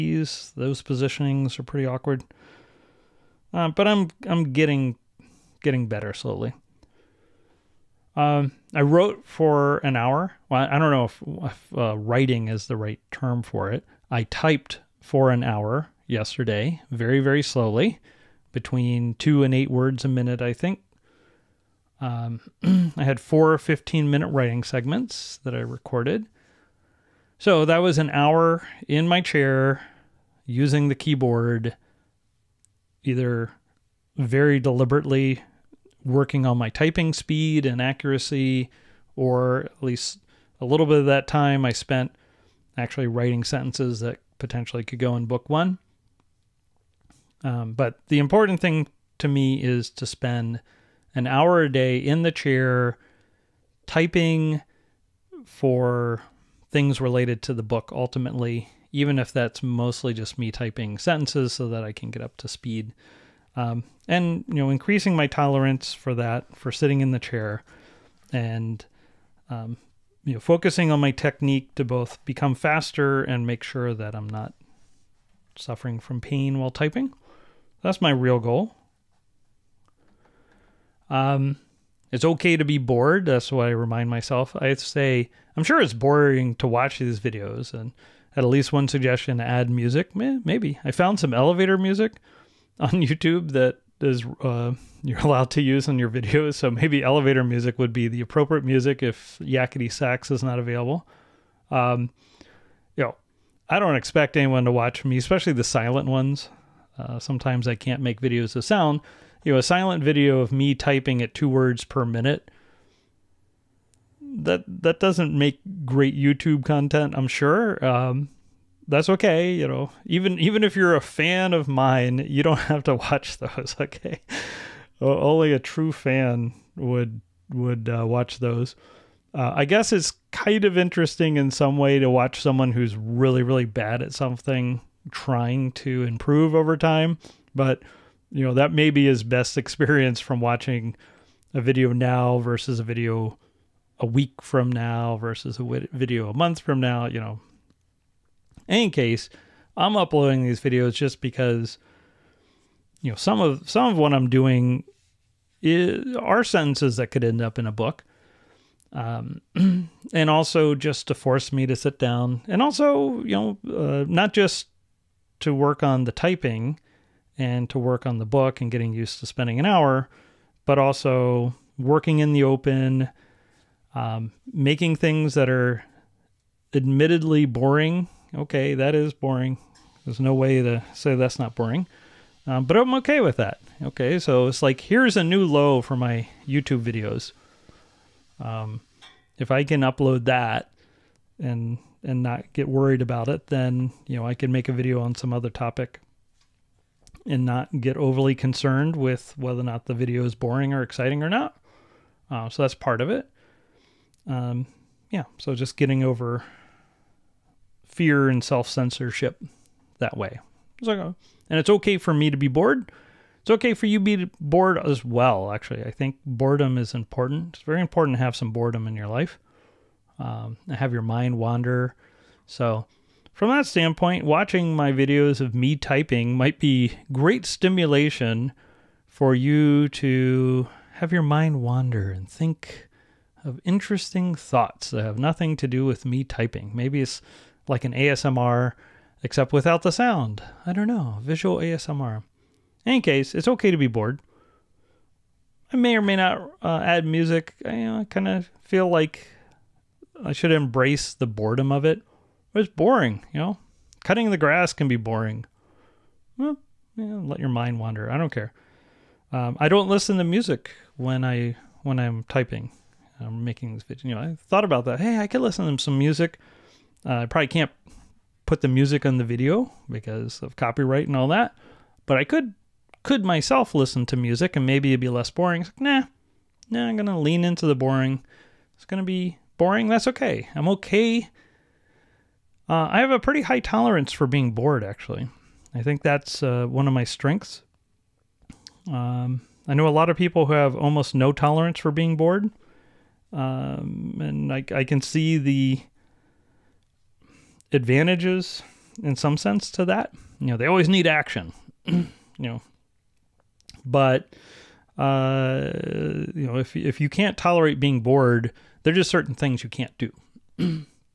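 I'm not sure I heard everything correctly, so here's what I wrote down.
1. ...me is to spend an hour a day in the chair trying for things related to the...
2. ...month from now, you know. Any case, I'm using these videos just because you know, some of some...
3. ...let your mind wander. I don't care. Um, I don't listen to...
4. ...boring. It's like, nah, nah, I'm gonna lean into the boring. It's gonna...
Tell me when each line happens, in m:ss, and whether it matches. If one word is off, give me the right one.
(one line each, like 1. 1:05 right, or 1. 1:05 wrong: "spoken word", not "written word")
1. 0:49 wrong: "typing", not "trying"
2. 2:26 wrong: "uploading", not "using"
3. 4:17 right
4. 4:35 right.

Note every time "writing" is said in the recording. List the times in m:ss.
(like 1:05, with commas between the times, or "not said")
0:11, 0:24, 0:43.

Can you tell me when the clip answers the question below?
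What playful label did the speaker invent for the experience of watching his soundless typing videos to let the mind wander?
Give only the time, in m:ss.
4:01.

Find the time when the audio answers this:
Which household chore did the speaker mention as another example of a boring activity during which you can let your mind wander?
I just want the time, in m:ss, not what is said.
4:14.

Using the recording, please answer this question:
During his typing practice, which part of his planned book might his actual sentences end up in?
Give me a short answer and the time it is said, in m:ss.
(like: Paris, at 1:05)
book one, at 0:45.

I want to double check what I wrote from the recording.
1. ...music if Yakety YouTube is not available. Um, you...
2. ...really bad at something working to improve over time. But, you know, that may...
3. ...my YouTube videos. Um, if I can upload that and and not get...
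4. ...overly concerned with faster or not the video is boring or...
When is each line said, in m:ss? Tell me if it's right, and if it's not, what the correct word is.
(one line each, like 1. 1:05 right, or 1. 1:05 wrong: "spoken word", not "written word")
1. 1:38 wrong: "Sax", not "YouTube"
2. 2:13 wrong: "trying", not "working"
3. 3:05 right
4. 3:17 wrong: "whether", not "faster".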